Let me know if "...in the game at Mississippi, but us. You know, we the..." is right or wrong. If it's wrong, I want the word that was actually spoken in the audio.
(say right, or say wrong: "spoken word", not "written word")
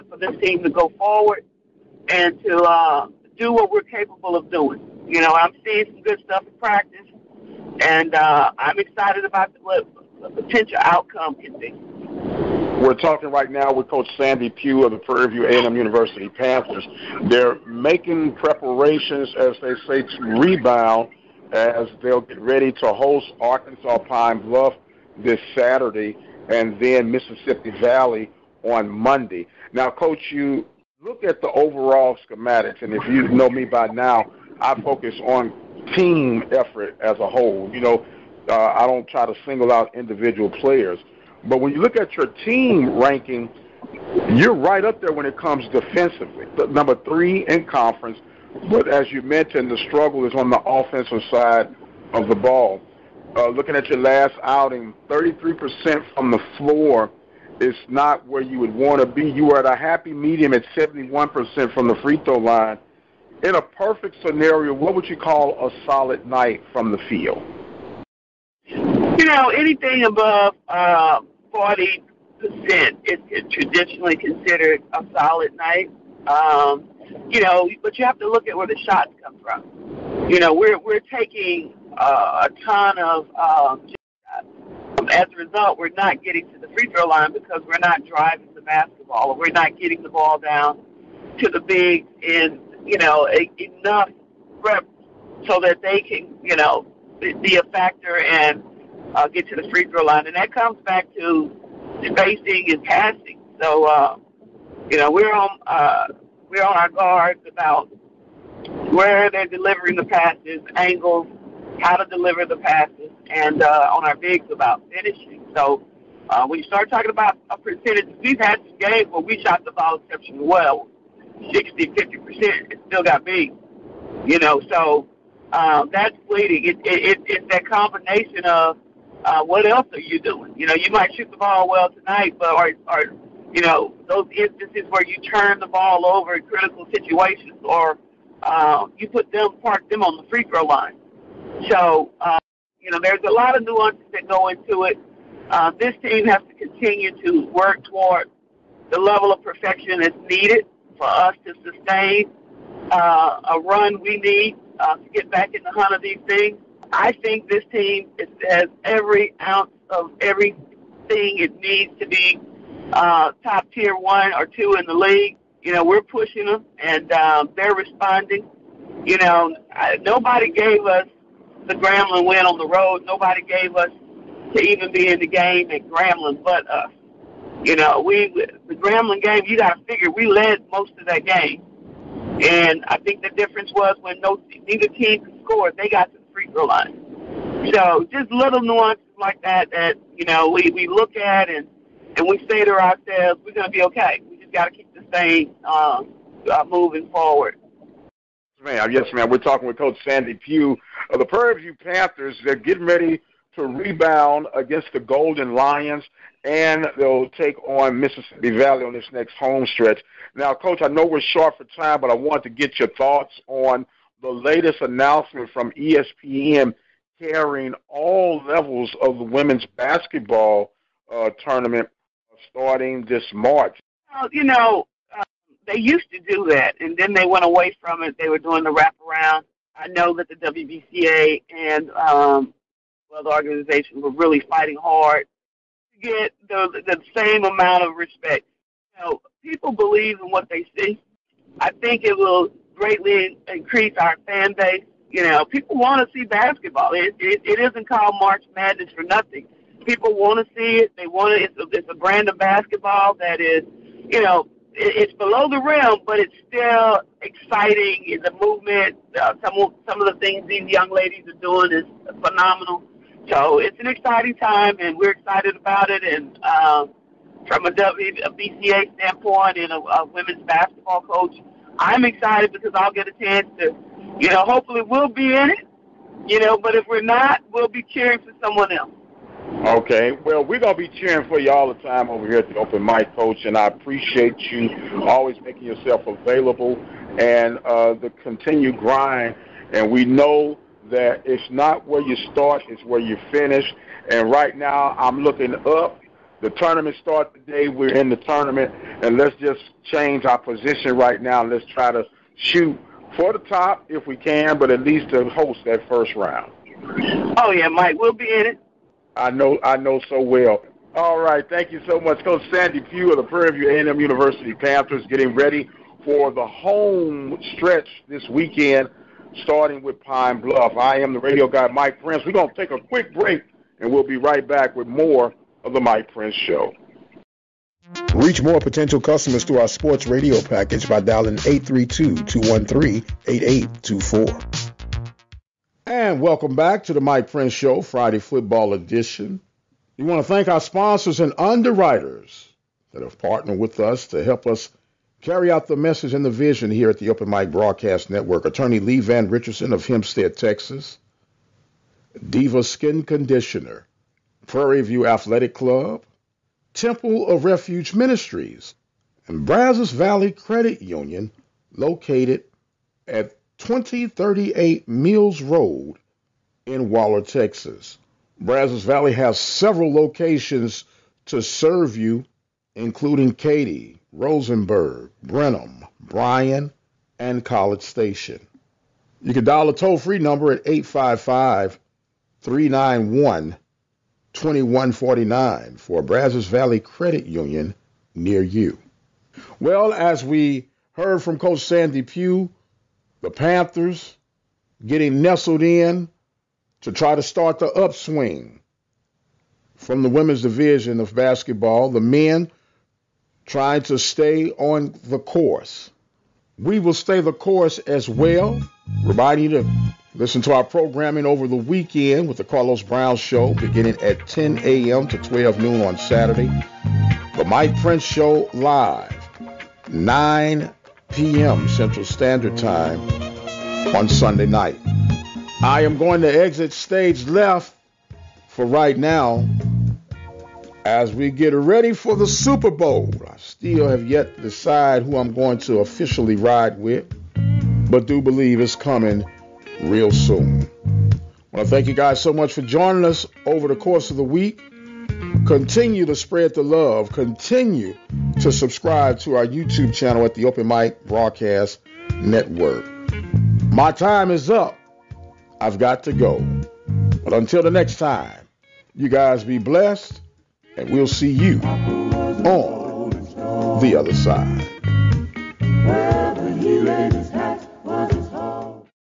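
wrong: "Grambling", not "Mississippi".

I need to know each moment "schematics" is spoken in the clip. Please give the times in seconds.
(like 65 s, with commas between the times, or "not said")
32 s.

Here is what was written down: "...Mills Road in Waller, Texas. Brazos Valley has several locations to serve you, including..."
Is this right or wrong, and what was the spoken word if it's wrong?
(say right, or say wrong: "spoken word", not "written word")
right.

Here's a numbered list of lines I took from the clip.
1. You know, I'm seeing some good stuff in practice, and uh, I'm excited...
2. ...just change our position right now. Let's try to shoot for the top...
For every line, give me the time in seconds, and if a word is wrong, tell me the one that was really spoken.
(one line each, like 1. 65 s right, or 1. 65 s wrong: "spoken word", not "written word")
1. 5 s right
2. 299 s right.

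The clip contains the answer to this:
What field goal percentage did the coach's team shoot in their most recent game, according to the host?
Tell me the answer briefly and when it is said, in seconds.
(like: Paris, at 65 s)
33%, at 55 s.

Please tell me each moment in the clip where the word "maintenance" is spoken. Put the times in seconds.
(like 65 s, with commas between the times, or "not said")
not said.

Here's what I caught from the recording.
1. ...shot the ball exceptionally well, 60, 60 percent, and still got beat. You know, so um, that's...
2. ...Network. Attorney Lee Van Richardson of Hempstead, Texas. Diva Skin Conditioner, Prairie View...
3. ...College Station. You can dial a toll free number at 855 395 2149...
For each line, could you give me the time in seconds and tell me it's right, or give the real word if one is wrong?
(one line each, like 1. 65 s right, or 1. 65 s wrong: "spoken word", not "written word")
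1. 119 s wrong: "50", not "60"
2. 348 s right
3. 377 s wrong: "391", not "395".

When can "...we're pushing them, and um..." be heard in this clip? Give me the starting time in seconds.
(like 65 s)
165 s.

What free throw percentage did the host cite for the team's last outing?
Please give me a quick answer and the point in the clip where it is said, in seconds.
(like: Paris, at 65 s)
71%, at 60 s.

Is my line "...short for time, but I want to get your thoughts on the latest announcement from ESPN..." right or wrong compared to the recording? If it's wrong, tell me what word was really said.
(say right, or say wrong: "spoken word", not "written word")
right.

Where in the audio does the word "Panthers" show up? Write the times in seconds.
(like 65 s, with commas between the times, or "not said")
16 s, 201 s, 314 s, 393 s.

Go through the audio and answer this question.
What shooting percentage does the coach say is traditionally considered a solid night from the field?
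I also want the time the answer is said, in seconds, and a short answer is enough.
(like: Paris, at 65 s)
40%, at 71 s.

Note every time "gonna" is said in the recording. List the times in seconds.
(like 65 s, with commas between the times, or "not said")
193 s, 322 s.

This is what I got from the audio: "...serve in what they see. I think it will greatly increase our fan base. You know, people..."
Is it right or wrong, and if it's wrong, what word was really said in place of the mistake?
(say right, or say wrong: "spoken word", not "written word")
wrong: "believe", not "serve".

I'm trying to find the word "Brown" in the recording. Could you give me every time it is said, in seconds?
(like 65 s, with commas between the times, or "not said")
412 s.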